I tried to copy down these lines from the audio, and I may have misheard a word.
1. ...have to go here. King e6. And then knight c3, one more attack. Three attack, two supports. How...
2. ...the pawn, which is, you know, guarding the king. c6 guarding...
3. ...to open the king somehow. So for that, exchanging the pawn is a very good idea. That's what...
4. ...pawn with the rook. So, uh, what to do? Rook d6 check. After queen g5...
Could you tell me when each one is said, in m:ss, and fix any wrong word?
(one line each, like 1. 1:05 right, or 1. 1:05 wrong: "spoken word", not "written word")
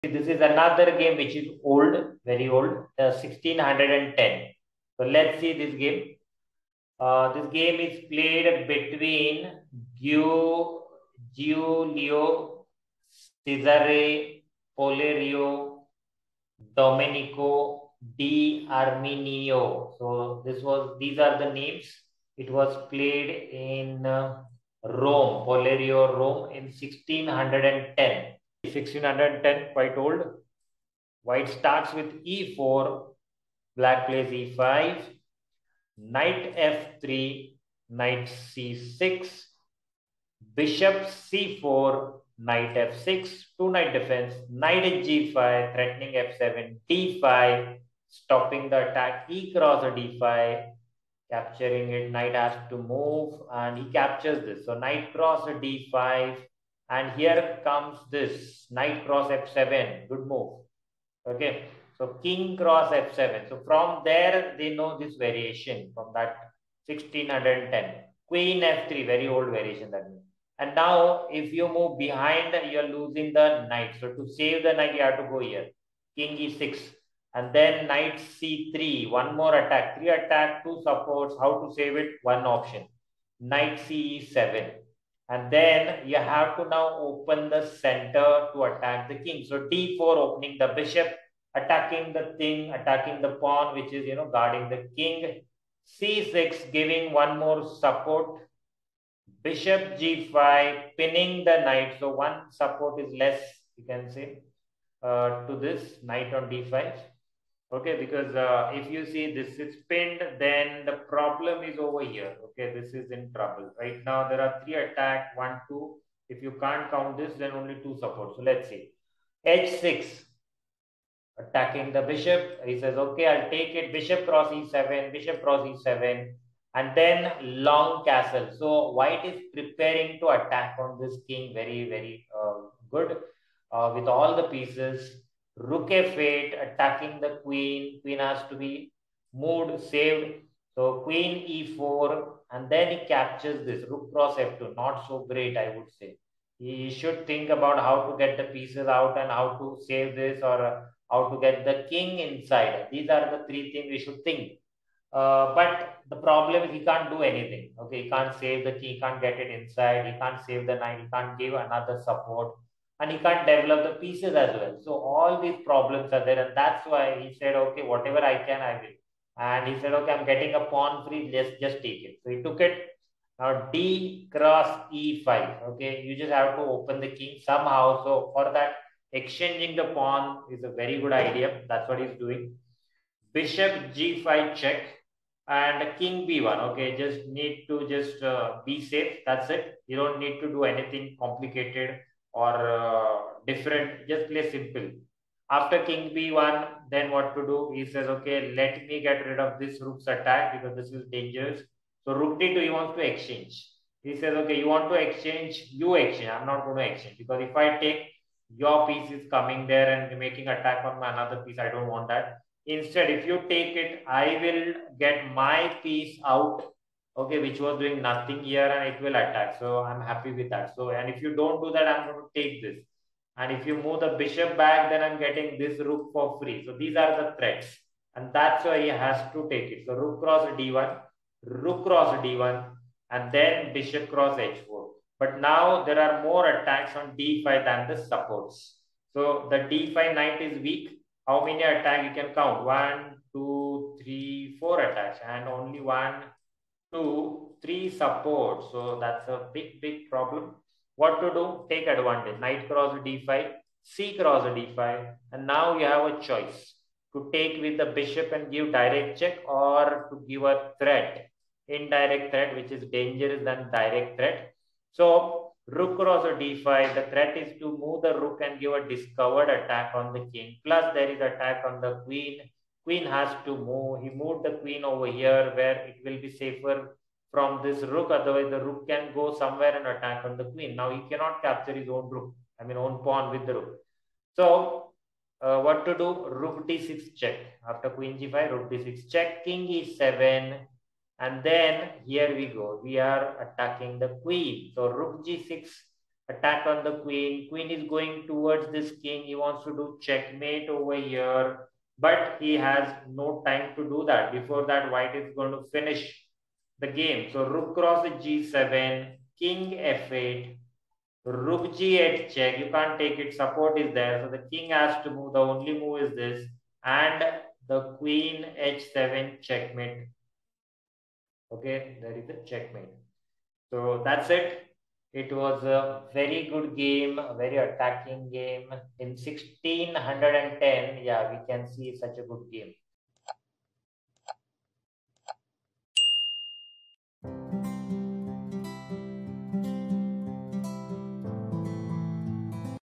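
1. 1:15 right
2. 1:33 wrong: "giving", not "guarding"
3. 2:56 right
4. 4:43 right.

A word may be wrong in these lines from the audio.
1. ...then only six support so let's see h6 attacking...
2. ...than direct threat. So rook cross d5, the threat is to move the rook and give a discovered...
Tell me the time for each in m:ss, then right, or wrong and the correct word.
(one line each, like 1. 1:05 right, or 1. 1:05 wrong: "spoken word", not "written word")
1. 1:57 wrong: "two", not "six"
2. 4:23 right.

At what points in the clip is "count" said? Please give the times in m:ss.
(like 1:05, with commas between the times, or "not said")
1:56, 4:02.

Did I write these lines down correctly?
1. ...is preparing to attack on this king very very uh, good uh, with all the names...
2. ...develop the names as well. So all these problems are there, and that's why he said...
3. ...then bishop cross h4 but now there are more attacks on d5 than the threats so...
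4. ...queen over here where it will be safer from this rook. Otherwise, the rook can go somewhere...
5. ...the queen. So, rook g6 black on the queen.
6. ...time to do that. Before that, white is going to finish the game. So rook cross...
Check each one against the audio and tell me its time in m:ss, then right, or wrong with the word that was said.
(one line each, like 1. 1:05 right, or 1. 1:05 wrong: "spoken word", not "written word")
1. 2:09 wrong: "pieces", not "names"
2. 2:43 wrong: "pieces", not "names"
3. 3:53 wrong: "supports", not "threats"
4. 4:34 right
5. 4:53 wrong: "attack", not "black"
6. 5:03 right.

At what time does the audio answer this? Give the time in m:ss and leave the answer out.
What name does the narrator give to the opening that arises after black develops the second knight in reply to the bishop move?
0:43.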